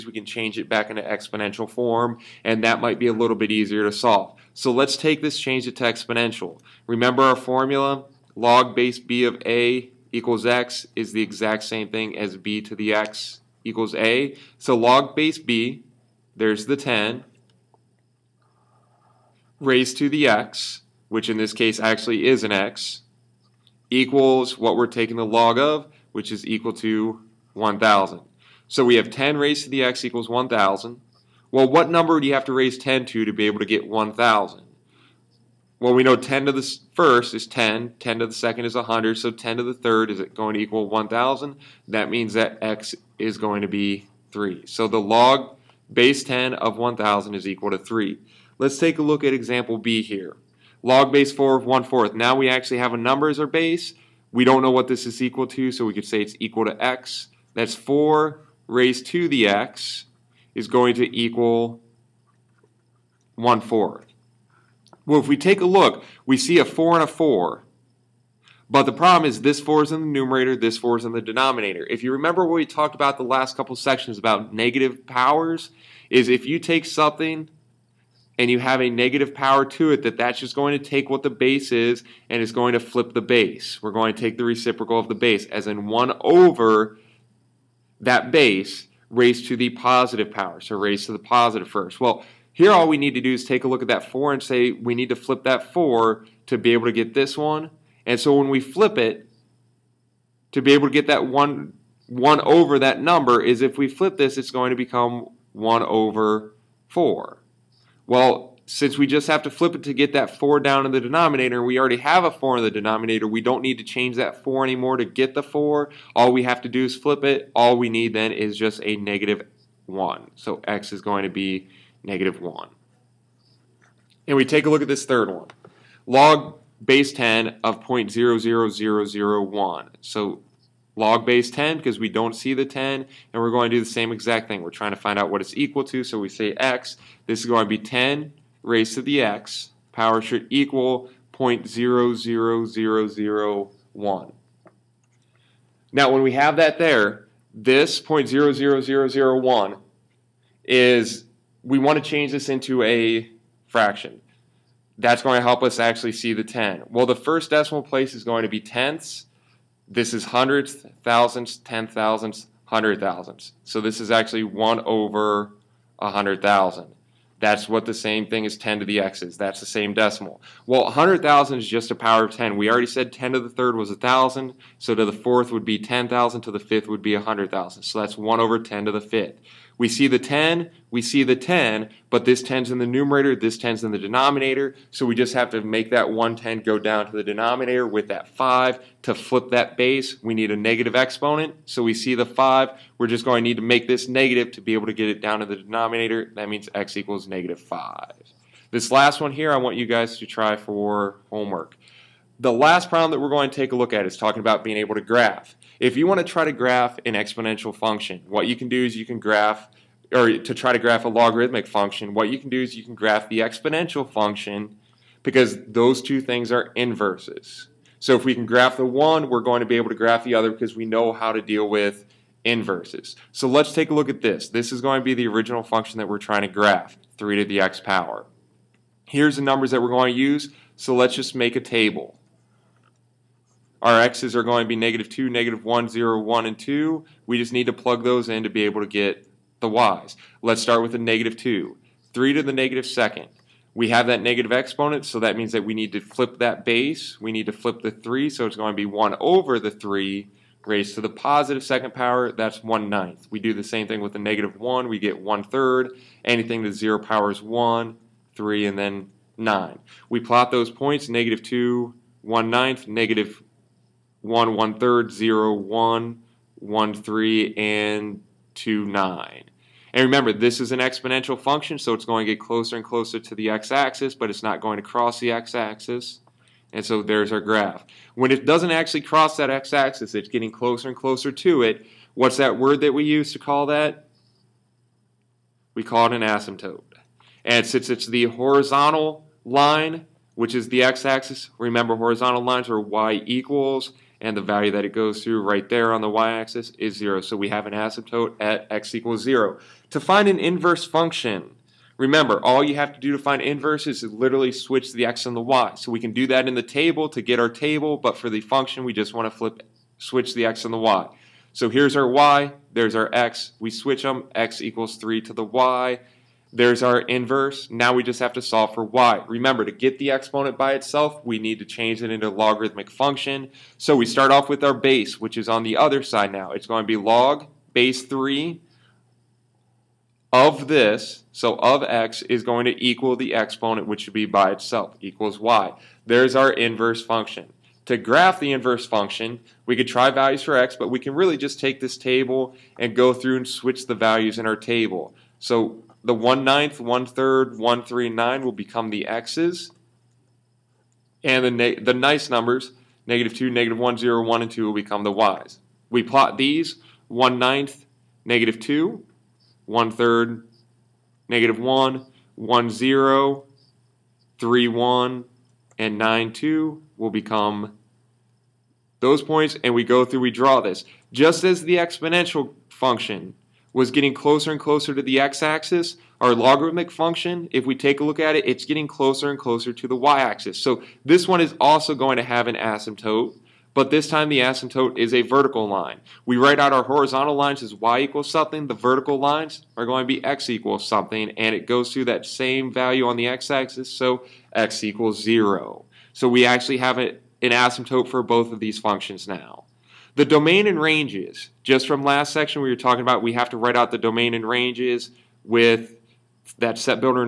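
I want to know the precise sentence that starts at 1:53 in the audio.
We don't need to change that 4 anymore to get the 4.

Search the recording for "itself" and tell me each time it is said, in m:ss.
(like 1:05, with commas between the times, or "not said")
5:20, 5:34.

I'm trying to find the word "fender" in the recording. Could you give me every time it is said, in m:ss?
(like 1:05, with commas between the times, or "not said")
not said.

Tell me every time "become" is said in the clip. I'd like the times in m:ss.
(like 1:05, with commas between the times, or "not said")
1:44, 5:48, 5:54, 6:07.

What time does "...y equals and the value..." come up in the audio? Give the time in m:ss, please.
4:52.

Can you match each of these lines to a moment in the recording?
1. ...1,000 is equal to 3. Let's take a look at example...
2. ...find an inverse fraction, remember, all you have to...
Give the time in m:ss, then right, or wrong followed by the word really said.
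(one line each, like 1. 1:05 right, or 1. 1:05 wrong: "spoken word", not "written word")
1. 0:46 right
2. 5:00 wrong: "function", not "fraction".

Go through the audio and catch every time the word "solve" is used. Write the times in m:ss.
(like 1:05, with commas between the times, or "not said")
0:03, 5:18.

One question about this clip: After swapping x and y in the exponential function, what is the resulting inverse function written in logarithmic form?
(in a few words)
log base 3 of x.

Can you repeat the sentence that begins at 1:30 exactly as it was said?
So raised to the positive first.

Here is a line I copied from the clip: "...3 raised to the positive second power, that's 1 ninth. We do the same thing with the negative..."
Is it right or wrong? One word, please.
right.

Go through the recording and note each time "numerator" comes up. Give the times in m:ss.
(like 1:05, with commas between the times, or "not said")
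1:10, 3:02.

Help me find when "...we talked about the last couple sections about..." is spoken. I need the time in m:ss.
1:12.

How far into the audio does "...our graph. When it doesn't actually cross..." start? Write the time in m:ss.
4:37.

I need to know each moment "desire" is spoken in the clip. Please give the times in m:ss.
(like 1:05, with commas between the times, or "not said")
not said.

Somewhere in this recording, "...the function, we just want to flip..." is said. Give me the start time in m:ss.
5:08.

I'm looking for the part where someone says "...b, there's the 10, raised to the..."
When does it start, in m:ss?
0:15.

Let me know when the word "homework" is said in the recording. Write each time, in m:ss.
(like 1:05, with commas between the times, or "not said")
3:21.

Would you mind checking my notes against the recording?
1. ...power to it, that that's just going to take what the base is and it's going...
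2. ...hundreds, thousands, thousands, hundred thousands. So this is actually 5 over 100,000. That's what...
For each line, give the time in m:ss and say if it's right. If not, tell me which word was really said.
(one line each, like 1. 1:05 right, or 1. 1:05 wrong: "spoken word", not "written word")
1. 1:19 right
2. 2:40 wrong: "1", not "5".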